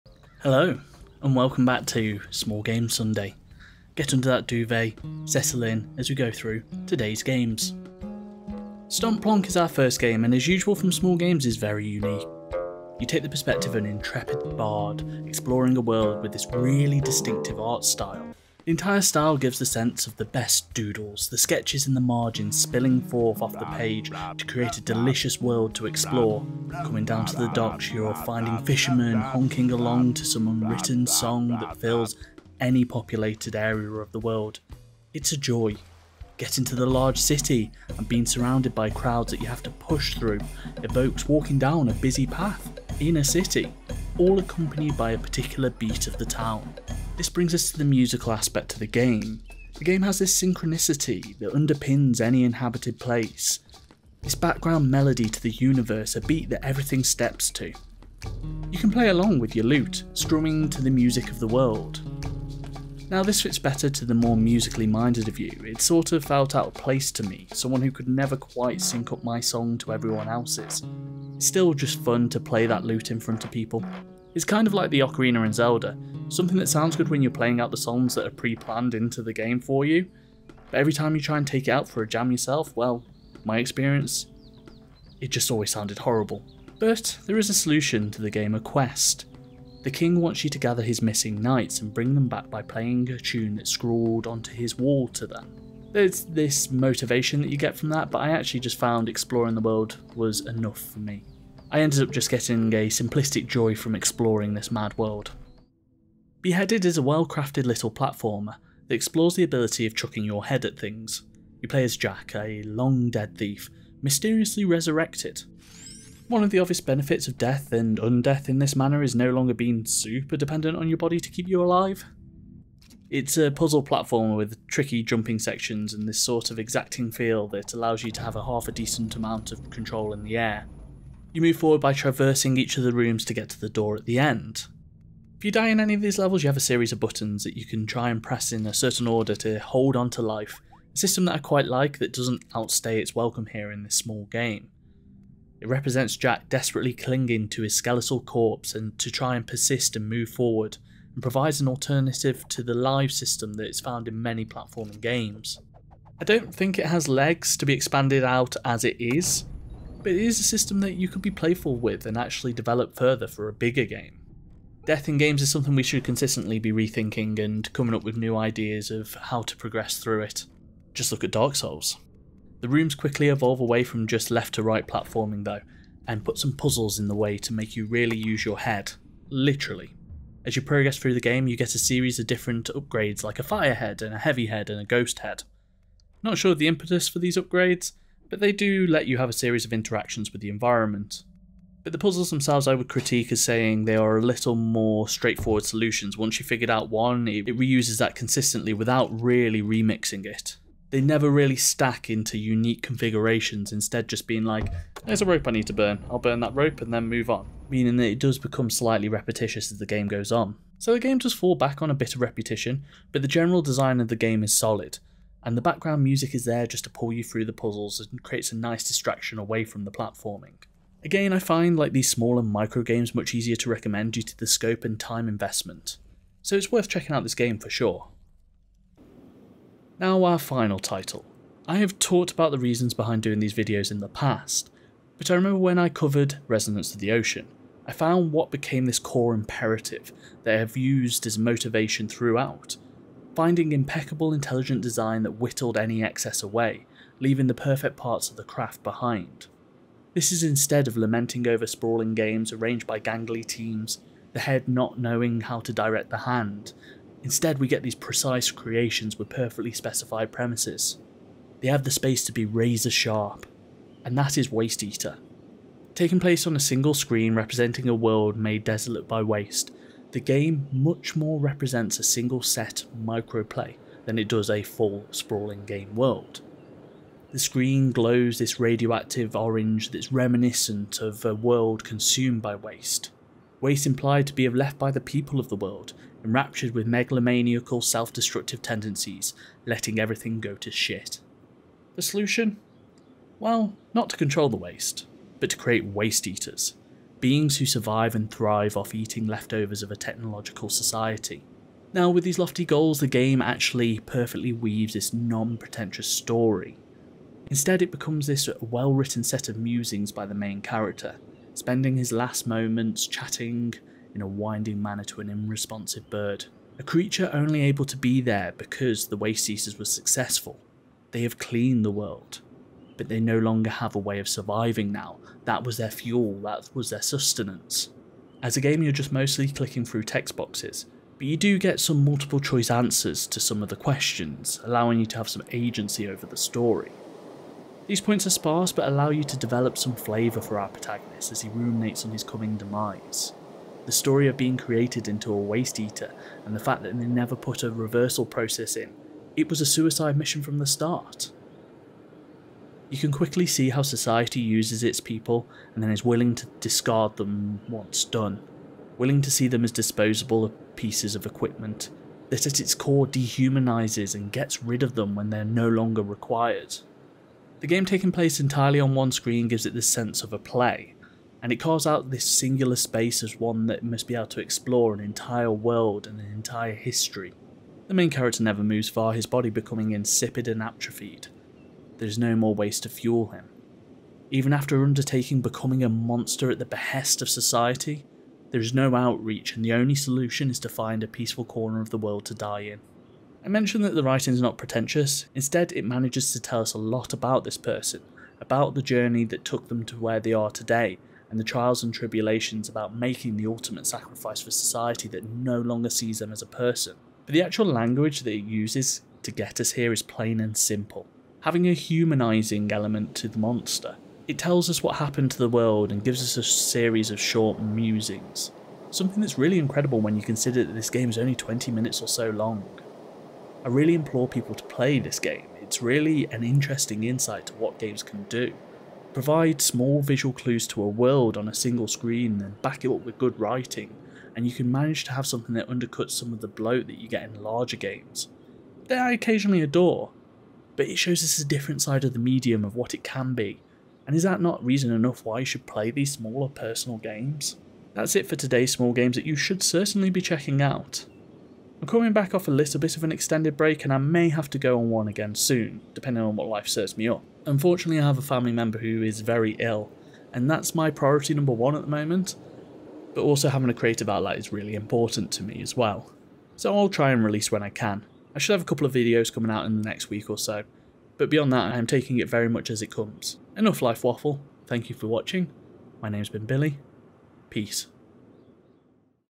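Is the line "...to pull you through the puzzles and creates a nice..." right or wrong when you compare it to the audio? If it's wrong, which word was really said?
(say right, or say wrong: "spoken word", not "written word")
right.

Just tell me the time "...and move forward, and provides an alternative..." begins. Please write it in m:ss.
2:29.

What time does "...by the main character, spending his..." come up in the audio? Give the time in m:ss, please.
5:10.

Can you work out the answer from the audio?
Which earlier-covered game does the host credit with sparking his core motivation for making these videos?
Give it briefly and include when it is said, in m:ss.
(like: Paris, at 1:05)
Resonance of the Ocean, at 3:56.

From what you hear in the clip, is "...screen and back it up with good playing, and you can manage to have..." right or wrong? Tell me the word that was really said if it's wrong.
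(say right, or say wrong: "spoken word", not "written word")
wrong: "writing", not "playing".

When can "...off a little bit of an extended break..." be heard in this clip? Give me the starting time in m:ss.
7:32.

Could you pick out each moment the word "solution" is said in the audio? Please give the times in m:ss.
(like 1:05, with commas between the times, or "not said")
1:27, 3:15, 4:52, 6:29.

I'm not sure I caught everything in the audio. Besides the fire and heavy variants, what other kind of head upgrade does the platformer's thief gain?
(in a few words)
ghost head.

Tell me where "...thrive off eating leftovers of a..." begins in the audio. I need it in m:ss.
4:58.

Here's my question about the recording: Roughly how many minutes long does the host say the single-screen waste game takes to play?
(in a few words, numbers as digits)
20.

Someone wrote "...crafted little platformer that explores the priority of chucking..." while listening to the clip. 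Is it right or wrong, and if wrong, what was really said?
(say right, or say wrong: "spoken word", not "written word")
wrong: "ability", not "priority".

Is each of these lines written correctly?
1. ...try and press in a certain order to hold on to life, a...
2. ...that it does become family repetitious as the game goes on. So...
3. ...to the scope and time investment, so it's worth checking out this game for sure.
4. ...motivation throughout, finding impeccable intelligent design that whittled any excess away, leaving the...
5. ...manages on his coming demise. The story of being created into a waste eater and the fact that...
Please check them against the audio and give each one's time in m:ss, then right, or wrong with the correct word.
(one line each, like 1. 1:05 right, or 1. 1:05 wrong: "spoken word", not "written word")
1. 2:17 right
2. 3:27 wrong: "slightly", not "family"
3. 3:44 right
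4. 4:01 right
5. 5:41 wrong: "ruminates", not "manages".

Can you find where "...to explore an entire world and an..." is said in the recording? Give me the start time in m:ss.
6:14.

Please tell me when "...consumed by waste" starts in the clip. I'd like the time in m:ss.
4:41.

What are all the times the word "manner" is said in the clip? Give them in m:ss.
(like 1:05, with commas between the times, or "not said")
1:58, 5:14.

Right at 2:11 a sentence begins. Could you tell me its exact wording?
You move forward by traversing each of the rooms to get to the door at the end.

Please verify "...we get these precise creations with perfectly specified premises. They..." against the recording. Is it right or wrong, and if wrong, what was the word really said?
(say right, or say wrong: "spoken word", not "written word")
right.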